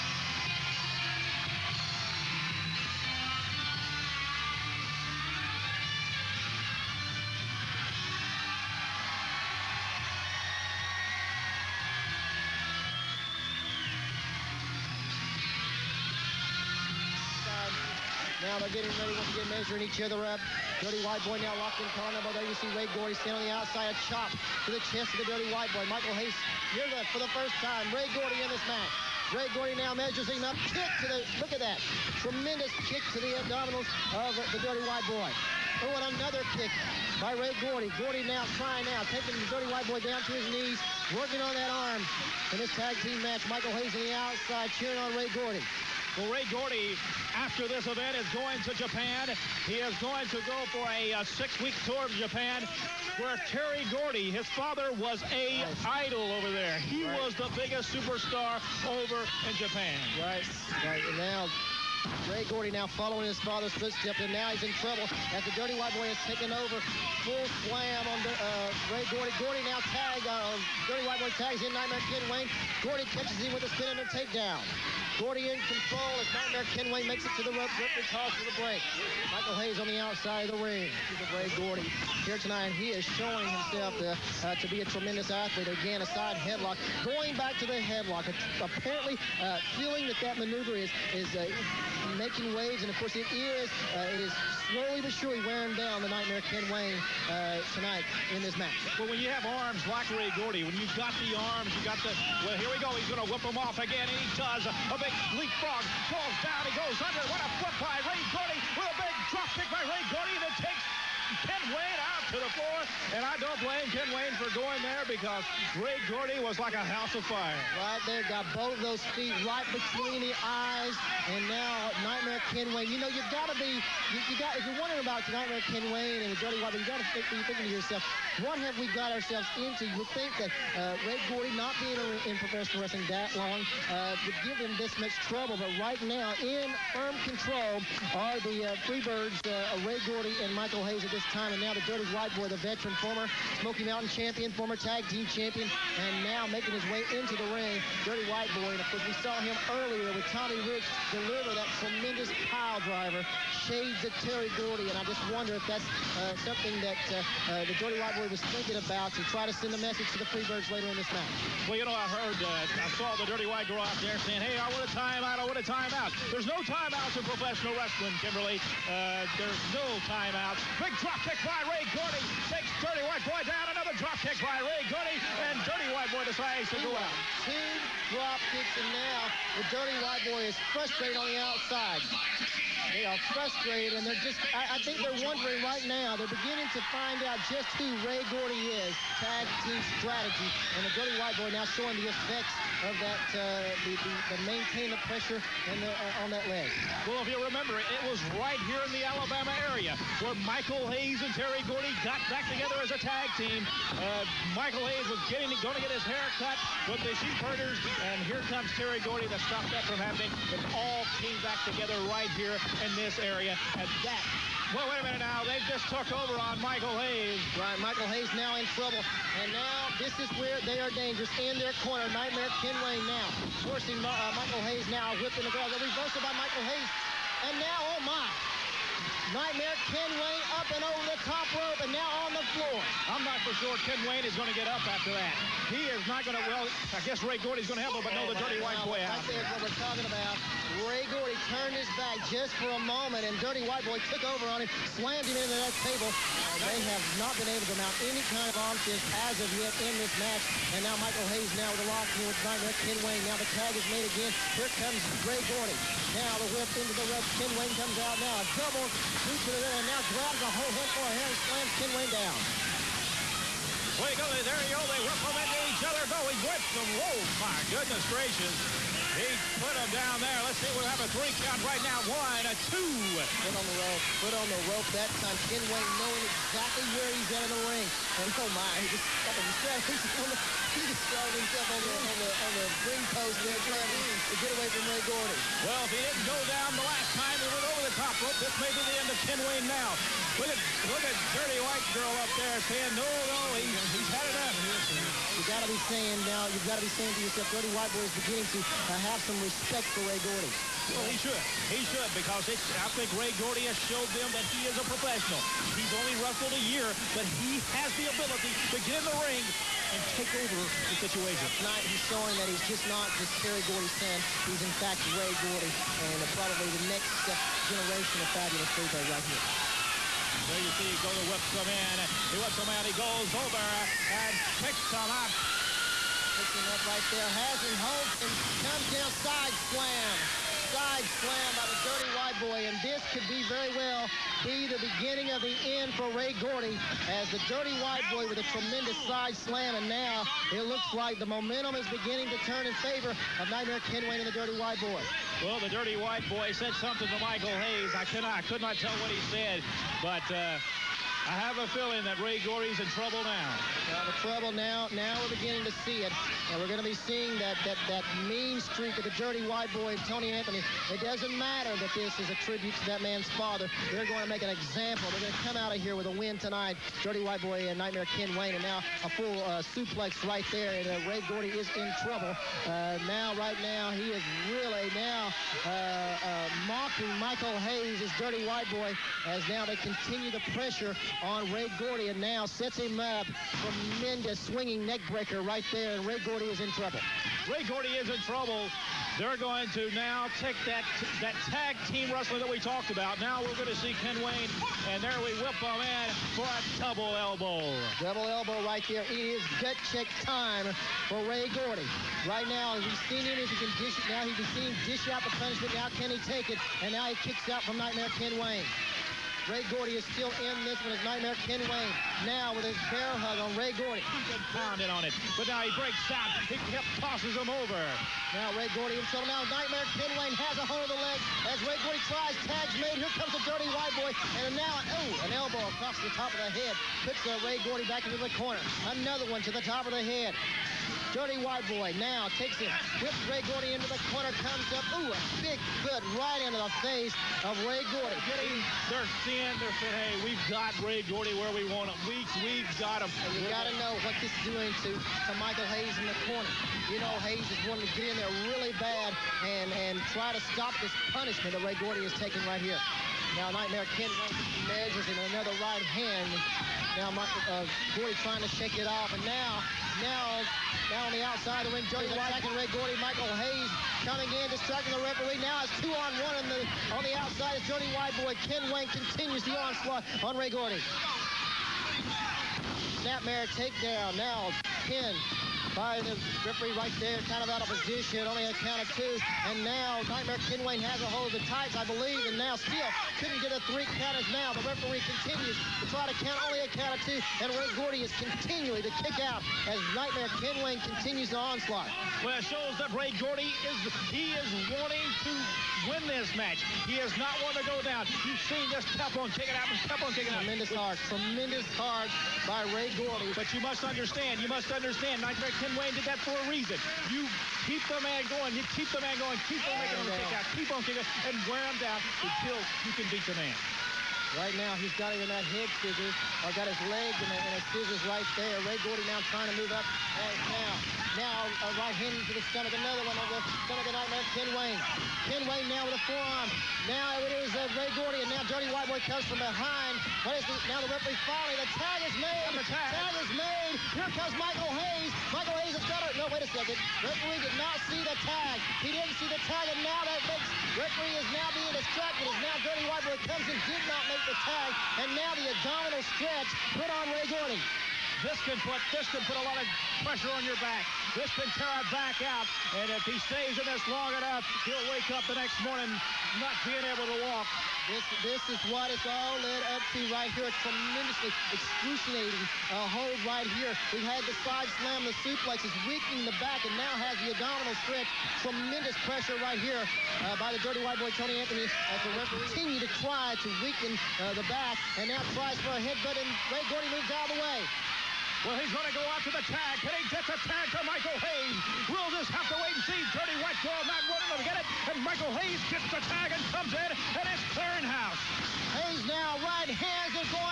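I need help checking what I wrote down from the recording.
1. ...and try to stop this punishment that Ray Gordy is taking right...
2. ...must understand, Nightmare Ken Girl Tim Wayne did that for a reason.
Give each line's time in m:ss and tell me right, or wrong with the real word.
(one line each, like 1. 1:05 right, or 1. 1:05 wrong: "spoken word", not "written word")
1. 7:29 right
2. 8:24 wrong: "Wayne", not "Girl".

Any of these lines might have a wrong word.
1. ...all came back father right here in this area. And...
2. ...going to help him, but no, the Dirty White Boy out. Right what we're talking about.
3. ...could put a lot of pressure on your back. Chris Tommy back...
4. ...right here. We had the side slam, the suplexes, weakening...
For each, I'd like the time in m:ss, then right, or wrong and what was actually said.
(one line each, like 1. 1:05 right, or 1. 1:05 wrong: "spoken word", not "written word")
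1. 3:30 wrong: "together", not "father"
2. 3:57 right
3. 9:09 wrong: "Ventura", not "Tommy"
4. 9:23 right.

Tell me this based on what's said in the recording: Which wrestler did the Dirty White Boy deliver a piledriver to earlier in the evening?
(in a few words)
Tommy Rich.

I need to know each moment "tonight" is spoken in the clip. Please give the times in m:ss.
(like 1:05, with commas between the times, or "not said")
1:22, 1:37, 5:11, 6:06.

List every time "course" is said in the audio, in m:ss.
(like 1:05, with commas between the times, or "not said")
1:32, 2:28.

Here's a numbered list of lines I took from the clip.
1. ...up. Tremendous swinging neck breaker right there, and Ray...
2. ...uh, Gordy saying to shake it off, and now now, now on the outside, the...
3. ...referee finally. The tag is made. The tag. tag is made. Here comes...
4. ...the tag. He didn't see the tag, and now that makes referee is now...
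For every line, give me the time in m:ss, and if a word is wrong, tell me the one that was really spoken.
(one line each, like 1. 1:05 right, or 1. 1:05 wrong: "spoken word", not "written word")
1. 6:22 right
2. 7:37 wrong: "trying", not "saying"
3. 8:50 right
4. 8:58 right.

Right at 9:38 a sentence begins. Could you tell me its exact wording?
Well, he's going to go out to the tag.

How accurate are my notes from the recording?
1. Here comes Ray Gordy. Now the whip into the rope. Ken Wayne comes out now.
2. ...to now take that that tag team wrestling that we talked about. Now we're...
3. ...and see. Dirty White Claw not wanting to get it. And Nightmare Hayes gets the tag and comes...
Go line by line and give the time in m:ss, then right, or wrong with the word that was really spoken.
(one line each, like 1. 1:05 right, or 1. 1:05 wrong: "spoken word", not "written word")
1. 4:14 right
2. 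6:29 right
3. 9:42 wrong: "Michael", not "Nightmare".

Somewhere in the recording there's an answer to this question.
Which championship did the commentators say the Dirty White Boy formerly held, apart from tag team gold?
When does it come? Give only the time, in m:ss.
2:23.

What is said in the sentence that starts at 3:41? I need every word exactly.
In their corner, Nightmare Ken Wayne now.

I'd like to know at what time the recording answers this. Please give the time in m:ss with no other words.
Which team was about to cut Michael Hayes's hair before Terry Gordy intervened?
3:27.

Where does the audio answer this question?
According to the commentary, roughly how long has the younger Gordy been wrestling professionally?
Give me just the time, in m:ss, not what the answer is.
5:06.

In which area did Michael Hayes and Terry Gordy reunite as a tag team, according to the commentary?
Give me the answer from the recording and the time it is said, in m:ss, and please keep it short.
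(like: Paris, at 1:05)
Alabama, at 3:19.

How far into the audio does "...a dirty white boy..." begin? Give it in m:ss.
7:03.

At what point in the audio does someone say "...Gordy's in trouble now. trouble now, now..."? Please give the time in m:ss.
5:52.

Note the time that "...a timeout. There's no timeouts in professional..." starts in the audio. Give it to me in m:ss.
2:45.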